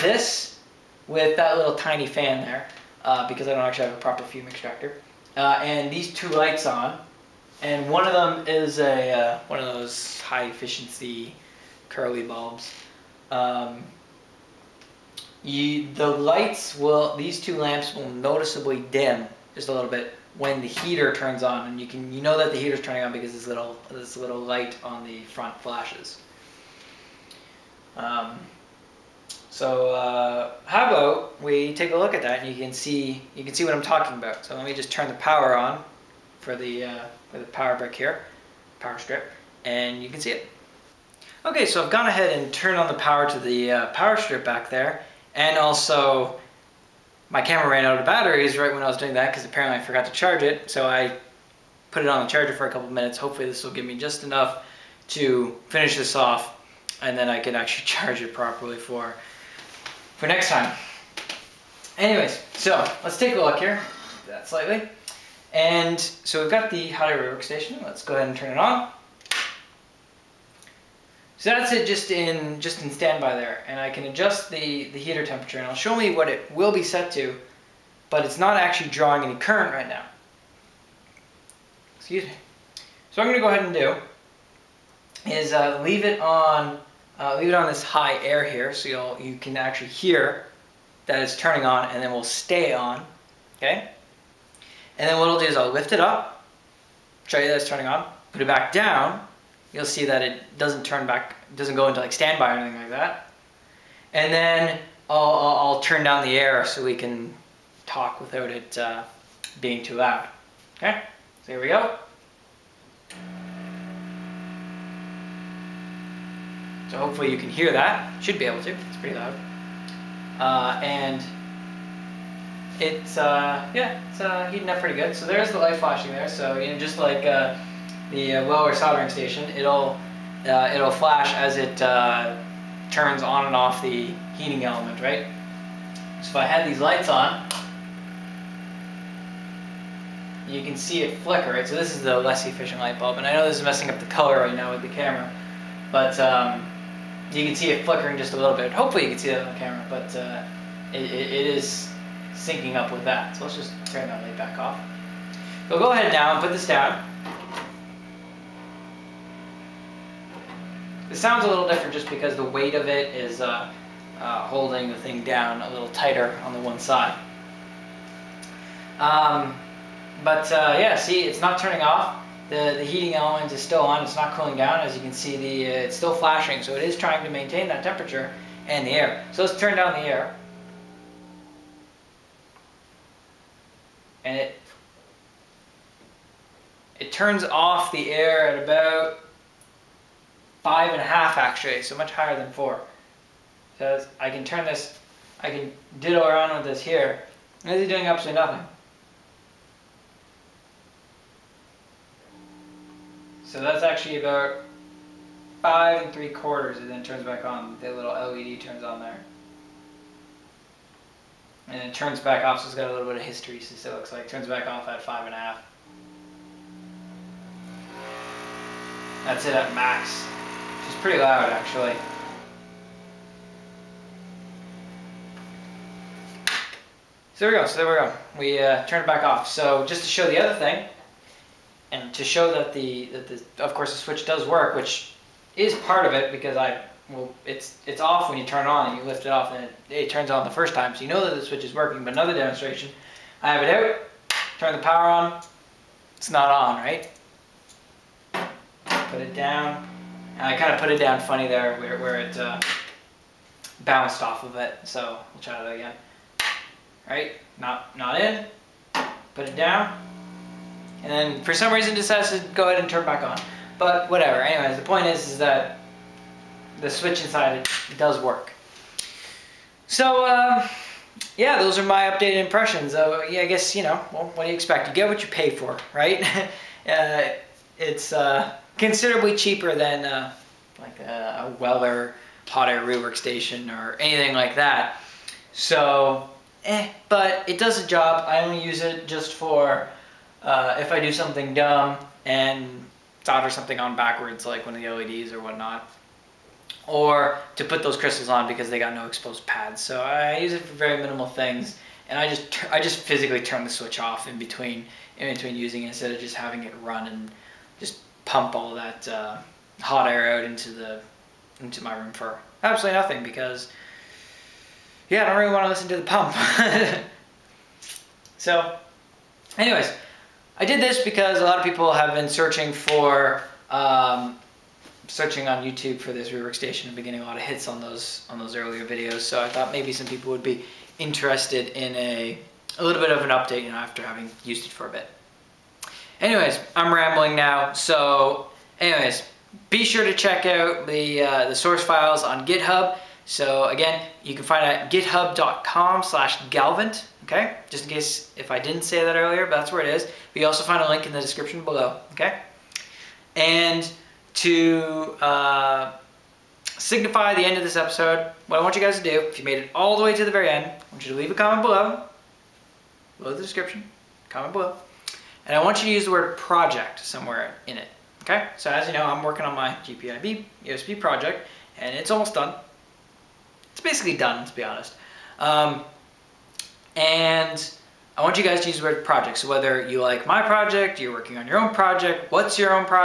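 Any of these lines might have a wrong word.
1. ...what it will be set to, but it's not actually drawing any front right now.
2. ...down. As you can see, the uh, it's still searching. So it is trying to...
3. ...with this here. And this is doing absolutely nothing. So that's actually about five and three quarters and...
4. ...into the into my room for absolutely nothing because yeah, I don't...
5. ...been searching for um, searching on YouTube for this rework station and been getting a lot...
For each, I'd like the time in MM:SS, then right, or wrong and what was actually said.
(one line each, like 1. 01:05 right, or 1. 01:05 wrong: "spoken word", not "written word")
1. 01:16 wrong: "current", not "front"
2. 02:54 wrong: "flashing", not "searching"
3. 03:16 right
4. 05:10 right
5. 05:22 right.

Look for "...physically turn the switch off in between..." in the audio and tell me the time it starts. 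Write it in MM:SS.
05:02.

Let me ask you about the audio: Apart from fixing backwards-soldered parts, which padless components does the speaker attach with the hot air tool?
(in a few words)
crystals.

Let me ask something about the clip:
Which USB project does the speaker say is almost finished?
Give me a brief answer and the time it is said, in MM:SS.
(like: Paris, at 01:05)
GPIB USB, at 06:09.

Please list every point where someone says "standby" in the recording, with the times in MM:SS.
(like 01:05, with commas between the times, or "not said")
01:12, 01:42.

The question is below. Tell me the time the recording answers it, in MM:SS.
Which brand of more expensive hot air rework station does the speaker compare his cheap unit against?
04:41.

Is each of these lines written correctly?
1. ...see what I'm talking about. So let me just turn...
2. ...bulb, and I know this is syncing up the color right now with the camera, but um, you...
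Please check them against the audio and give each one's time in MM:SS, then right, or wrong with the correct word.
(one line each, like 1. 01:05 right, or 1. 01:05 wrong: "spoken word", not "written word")
1. 00:33 right
2. 02:22 wrong: "messing", not "syncing".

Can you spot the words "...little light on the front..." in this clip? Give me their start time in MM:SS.
00:24.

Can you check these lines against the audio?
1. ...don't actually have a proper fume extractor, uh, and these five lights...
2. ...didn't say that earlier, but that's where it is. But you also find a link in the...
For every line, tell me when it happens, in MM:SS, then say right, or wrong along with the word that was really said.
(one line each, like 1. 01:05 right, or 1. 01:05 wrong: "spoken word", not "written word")
1. 00:03 wrong: "two", not "five"
2. 05:48 right.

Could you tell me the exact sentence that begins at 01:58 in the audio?
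Should be able to, it's pretty loud.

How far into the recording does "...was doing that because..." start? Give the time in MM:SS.
00:48.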